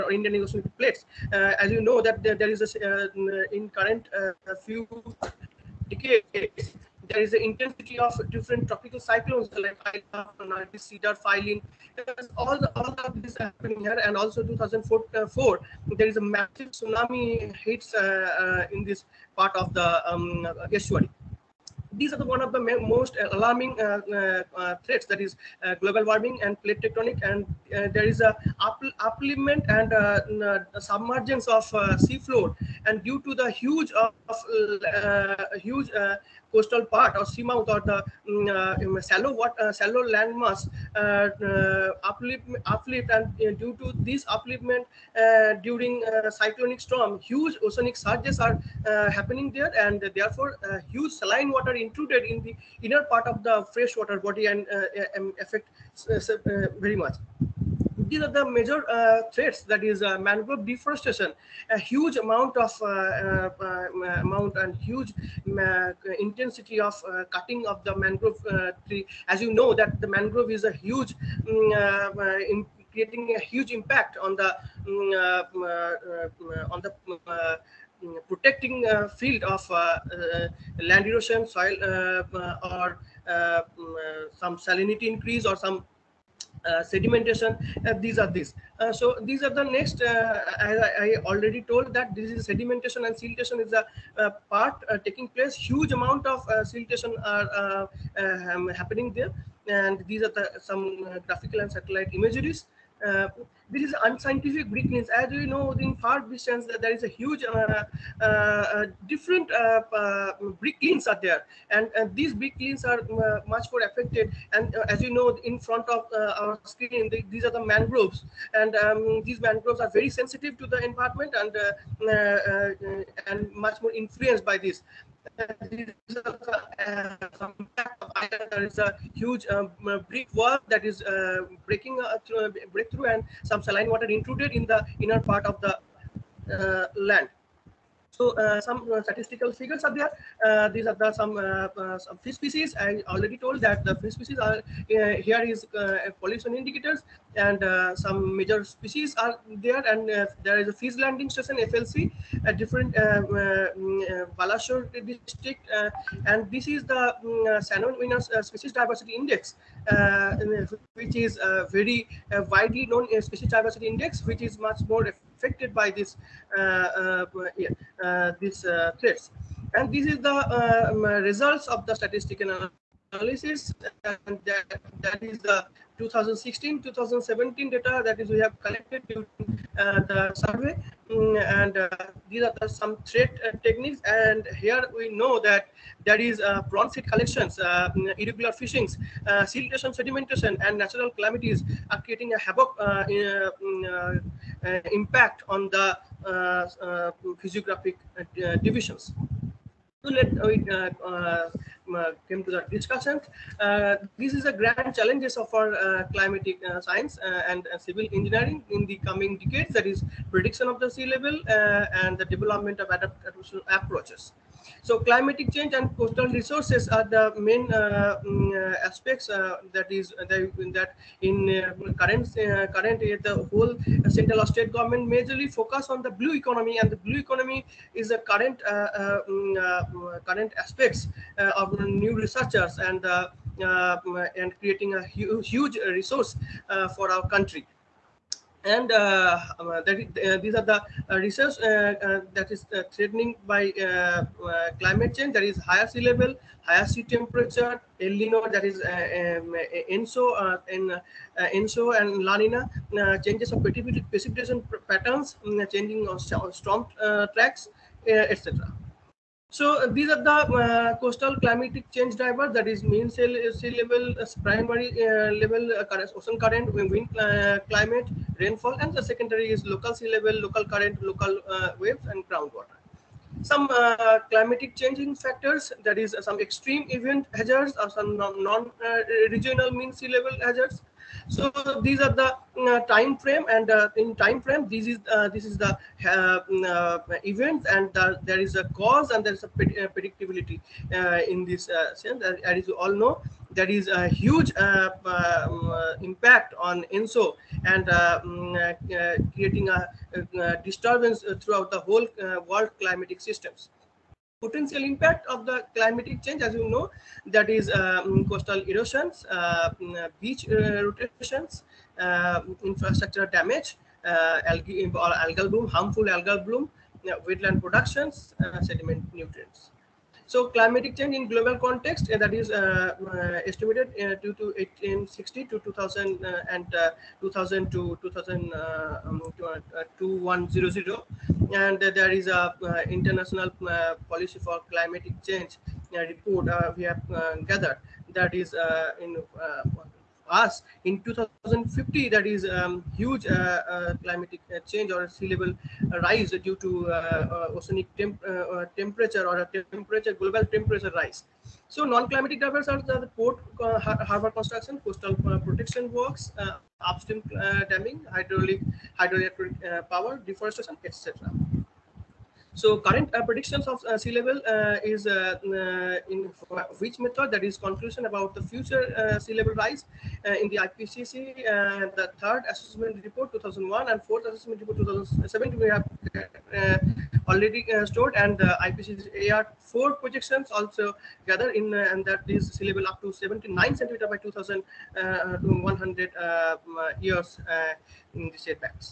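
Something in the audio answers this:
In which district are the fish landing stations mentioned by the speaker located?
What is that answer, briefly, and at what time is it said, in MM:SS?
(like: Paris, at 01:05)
Balashore, at 02:34.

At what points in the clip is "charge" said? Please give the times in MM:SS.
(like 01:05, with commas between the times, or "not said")
not said.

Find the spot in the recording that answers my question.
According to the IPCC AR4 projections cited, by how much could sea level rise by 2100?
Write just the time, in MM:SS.
06:23.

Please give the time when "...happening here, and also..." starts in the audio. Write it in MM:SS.
00:13.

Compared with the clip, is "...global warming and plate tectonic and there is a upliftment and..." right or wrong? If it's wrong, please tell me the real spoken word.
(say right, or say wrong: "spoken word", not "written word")
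right.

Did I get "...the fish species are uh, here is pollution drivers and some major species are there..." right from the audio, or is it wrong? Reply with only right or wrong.
wrong.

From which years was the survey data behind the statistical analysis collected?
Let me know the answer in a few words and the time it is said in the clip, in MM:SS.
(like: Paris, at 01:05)
2016-2017, at 02:55.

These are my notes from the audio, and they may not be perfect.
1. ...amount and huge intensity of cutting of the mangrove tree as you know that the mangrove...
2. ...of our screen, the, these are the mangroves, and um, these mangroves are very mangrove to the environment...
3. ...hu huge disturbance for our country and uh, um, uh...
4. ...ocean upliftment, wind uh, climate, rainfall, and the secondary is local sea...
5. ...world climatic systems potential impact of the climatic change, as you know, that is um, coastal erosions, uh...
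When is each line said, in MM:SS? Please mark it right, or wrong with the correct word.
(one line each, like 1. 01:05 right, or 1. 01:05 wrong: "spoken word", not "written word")
1. 01:04 right
2. 01:55 wrong: "sensitive", not "mangrove"
3. 03:55 wrong: "resource", not "disturbance"
4. 04:26 wrong: "current", not "upliftment"
5. 05:02 right.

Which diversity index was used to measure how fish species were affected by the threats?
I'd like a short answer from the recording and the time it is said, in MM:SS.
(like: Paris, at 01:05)
Shannon species diversity index, at 02:37.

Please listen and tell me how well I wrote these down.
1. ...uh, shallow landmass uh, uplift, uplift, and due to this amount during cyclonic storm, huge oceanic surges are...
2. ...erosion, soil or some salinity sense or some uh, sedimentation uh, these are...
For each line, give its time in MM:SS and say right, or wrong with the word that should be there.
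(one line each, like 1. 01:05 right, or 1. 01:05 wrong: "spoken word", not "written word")
1. 00:39 wrong: "upliftment", not "amount"
2. 01:21 wrong: "increase", not "sense".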